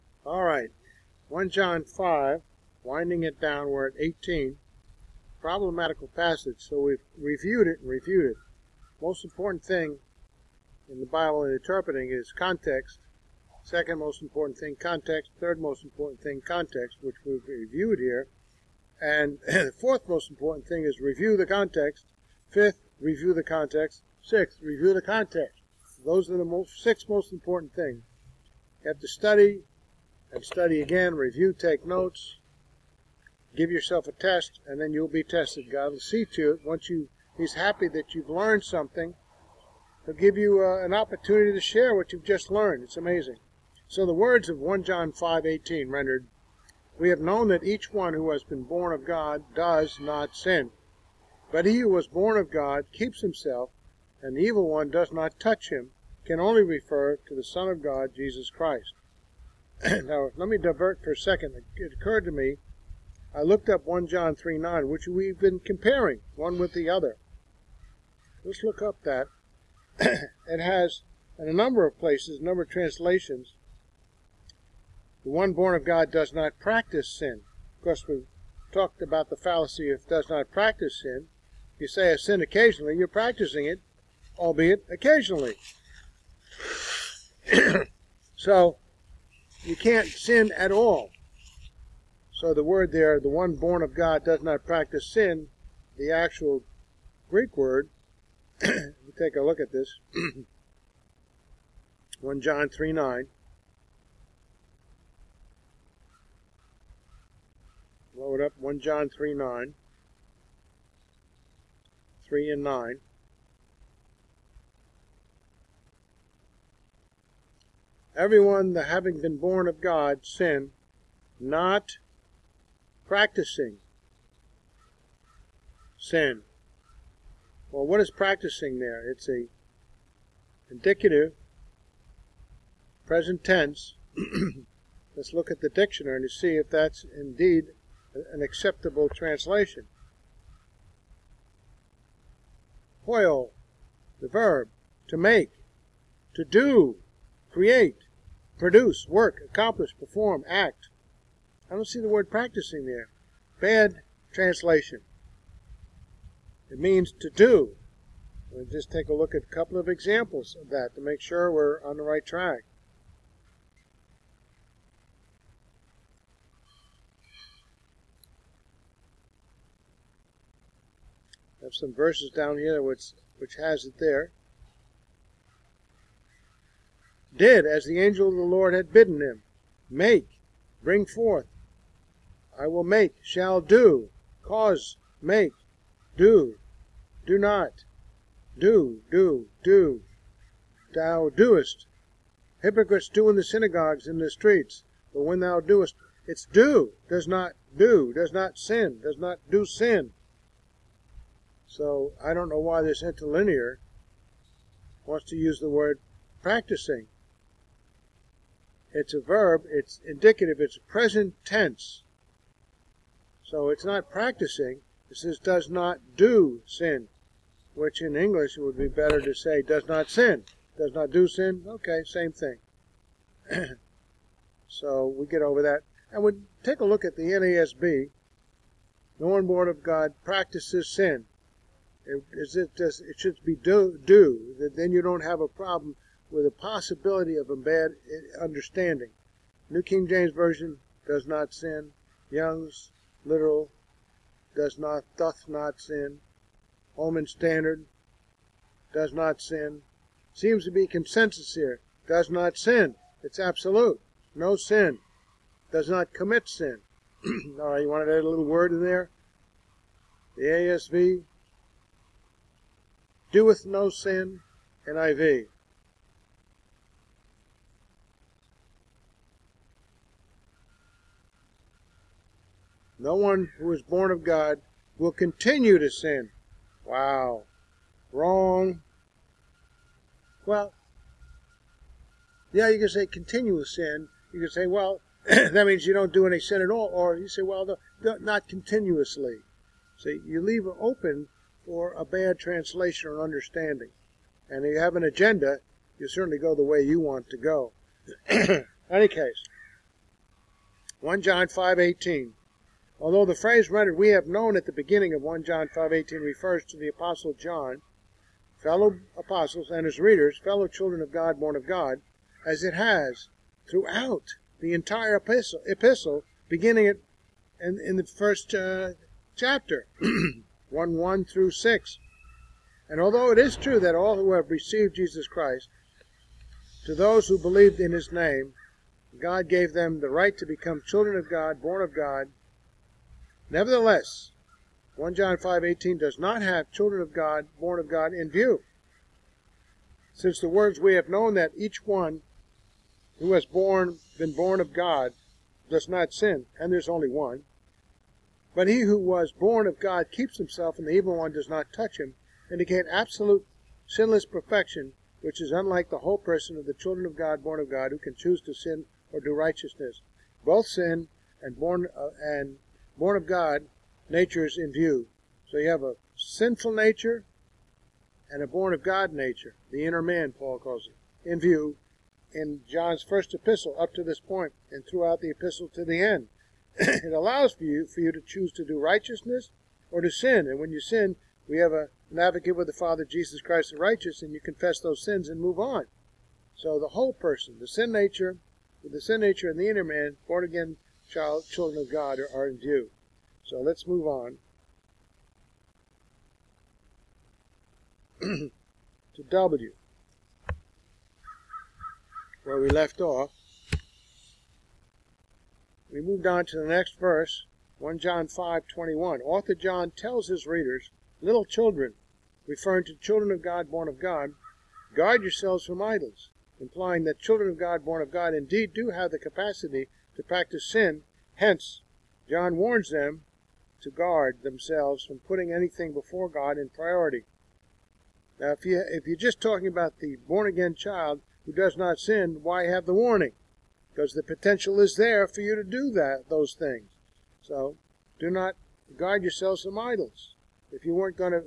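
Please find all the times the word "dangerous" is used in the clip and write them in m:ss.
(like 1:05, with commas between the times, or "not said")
not said.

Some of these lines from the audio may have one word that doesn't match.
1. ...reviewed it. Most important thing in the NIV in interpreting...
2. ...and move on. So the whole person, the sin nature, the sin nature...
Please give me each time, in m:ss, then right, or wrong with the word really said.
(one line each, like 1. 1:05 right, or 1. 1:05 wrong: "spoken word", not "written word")
1. 0:07 wrong: "Bible", not "NIV"
2. 6:25 right.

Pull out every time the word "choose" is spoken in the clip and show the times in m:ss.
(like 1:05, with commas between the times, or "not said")
5:58, 6:18.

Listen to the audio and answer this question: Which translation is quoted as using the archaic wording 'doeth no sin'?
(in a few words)
ASV.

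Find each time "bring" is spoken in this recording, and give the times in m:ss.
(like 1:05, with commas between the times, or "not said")
3:00.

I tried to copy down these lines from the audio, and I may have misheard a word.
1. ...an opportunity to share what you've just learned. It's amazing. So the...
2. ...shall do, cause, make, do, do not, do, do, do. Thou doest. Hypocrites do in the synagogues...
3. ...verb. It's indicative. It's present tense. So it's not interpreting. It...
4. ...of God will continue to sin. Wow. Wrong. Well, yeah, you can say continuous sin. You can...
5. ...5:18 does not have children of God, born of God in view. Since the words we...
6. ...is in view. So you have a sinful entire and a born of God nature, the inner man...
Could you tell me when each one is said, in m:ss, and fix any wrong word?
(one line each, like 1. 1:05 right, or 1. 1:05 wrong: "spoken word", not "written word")
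1. 0:40 right
2. 3:03 right
3. 3:29 wrong: "practicing", not "interpreting"
4. 4:34 right
5. 5:35 right
6. 6:04 wrong: "nature", not "entire".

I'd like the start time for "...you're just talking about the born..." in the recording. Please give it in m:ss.
7:09.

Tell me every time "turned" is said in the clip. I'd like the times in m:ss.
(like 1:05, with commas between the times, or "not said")
not said.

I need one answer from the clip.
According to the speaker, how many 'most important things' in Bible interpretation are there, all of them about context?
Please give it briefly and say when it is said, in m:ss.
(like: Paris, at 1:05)
6, at 0:26.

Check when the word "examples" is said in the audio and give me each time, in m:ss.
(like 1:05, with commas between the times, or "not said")
2:39.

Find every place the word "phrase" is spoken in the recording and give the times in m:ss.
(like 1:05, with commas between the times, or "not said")
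5:03.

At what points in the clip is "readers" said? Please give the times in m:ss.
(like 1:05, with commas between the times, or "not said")
5:10, 6:50.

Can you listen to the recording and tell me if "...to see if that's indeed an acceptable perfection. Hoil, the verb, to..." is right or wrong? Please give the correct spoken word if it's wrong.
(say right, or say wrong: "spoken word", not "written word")
wrong: "translation", not "perfection".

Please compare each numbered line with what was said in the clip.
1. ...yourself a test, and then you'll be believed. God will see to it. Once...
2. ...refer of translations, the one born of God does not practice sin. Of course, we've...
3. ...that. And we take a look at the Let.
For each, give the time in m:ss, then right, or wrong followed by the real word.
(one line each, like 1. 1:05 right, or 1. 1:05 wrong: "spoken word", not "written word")
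1. 0:33 wrong: "tested", not "believed"
2. 1:12 wrong: "number", not "refer"
3. 3:45 wrong: "NASB", not "Let".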